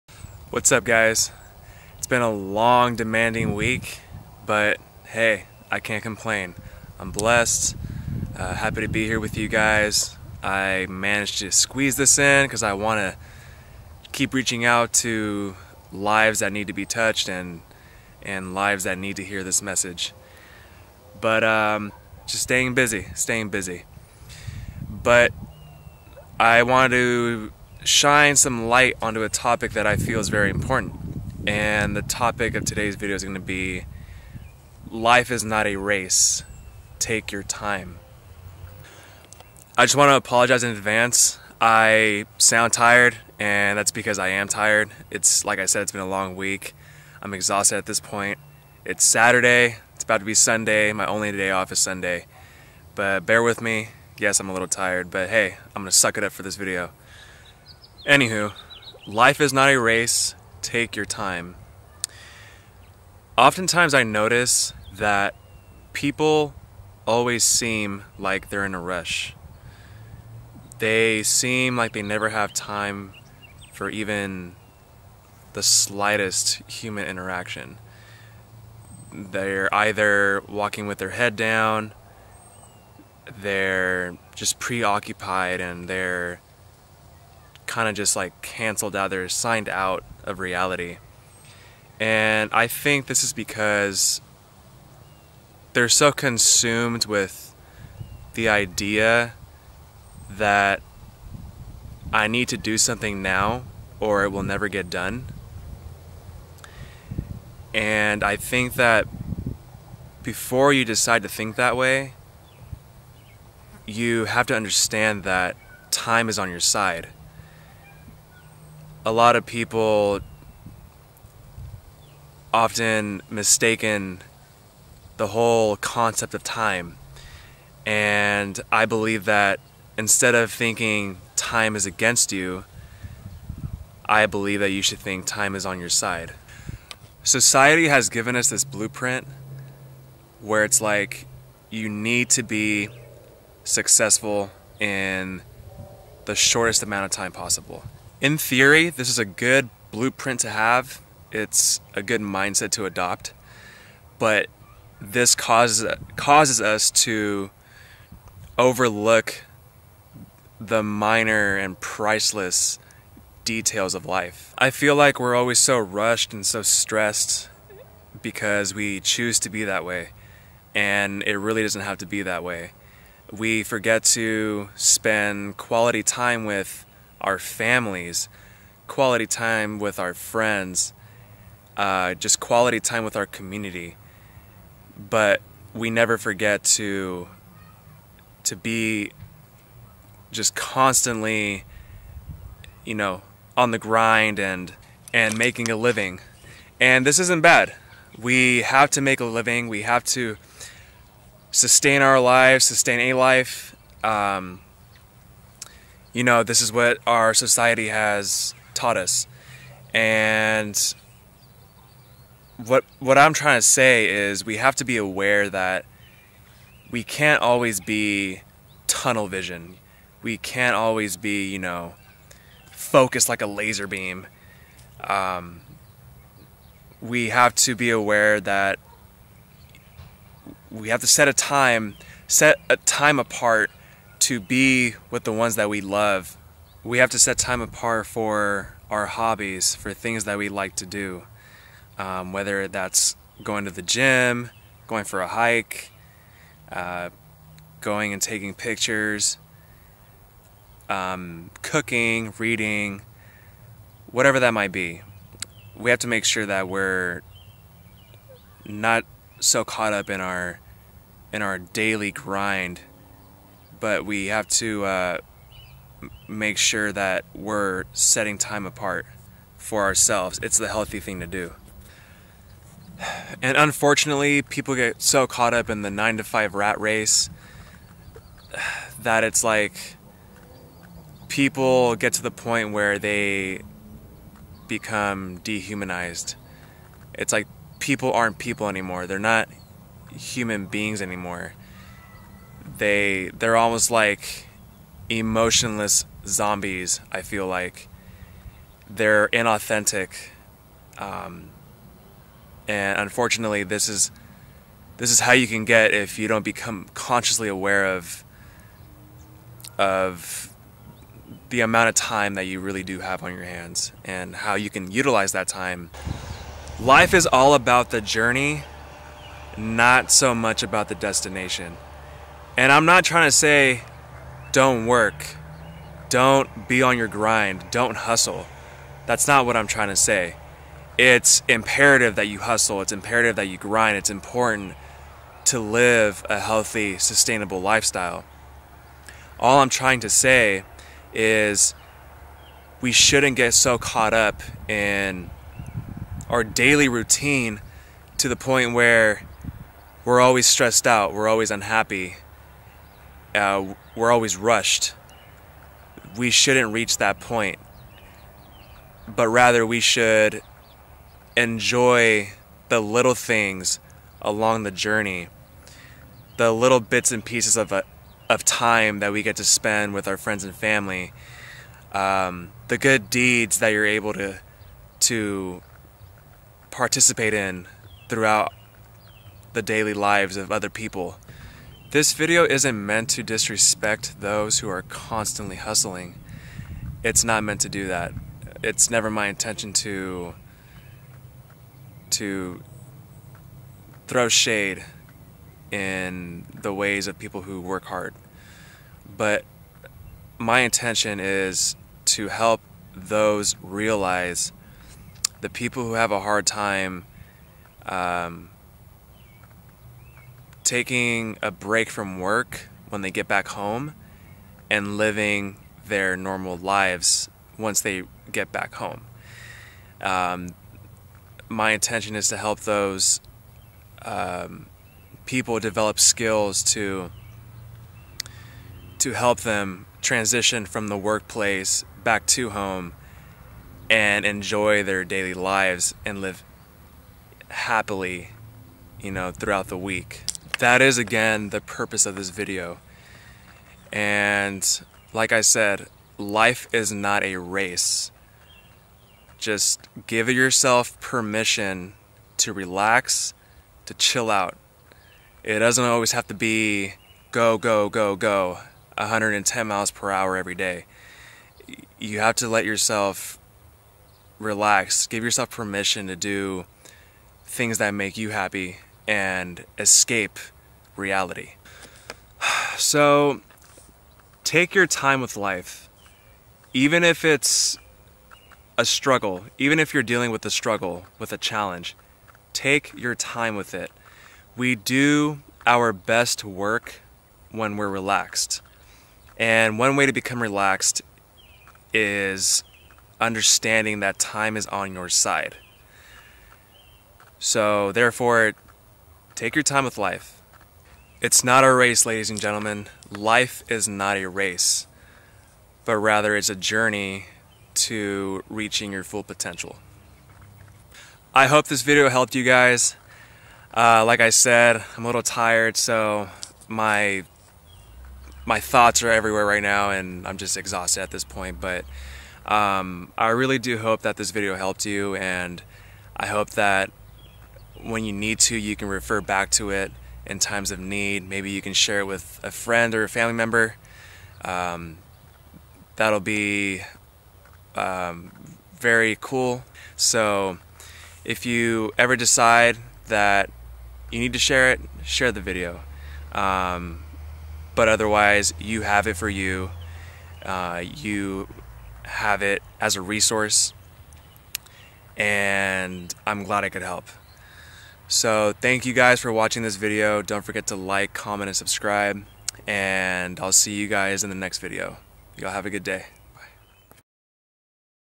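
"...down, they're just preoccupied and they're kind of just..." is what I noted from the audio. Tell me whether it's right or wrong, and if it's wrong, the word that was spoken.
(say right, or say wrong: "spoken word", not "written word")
right.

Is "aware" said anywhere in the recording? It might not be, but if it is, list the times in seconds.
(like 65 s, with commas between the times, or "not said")
214 s, 227 s, 307 s.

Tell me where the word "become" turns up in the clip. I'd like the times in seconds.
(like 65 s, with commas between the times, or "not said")
284 s, 306 s, 490 s.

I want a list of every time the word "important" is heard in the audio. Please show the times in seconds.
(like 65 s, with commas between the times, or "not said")
30 s, 334 s.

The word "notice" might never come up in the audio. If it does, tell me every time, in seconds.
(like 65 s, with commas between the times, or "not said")
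64 s.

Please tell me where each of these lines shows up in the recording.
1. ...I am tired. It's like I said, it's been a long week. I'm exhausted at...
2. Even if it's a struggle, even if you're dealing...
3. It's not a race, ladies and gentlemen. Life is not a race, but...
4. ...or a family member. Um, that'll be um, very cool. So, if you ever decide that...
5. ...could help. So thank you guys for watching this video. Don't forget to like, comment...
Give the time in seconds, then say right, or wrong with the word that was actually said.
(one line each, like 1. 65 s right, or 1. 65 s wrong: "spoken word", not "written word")
1. 44 s right
2. 476 s right
3. 501 s right
4. 532 s right
5. 556 s right.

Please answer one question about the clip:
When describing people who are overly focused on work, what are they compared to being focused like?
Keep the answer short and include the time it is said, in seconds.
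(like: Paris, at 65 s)
a laser beam, at 222 s.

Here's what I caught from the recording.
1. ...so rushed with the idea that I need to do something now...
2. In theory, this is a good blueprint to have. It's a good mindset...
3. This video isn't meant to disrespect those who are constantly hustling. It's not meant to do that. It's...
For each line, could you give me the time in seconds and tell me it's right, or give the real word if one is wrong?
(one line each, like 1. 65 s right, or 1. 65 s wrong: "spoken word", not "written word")
1. 95 s wrong: "consumed", not "rushed"
2. 148 s right
3. 381 s right.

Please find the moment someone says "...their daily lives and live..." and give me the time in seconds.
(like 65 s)
434 s.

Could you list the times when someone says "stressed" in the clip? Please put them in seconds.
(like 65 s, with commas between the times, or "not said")
166 s, 350 s.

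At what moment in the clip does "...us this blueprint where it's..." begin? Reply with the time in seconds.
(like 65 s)
138 s.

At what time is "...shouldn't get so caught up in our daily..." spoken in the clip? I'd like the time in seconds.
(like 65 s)
342 s.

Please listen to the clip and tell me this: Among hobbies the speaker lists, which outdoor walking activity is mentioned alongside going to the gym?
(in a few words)
going for a hike.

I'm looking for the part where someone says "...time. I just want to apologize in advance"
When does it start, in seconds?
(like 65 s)
37 s.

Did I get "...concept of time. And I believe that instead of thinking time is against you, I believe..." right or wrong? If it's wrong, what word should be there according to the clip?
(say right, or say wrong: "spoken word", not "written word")
right.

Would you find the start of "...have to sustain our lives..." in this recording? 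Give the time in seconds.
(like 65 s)
199 s.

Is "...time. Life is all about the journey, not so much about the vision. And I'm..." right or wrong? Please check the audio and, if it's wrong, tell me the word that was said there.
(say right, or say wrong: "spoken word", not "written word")
wrong: "destination", not "vision".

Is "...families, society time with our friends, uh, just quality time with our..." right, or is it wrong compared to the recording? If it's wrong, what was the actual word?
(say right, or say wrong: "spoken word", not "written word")
wrong: "quality", not "society".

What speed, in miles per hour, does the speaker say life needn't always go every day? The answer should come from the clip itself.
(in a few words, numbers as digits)
110.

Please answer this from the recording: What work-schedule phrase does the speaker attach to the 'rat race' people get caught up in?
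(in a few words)
nine to five.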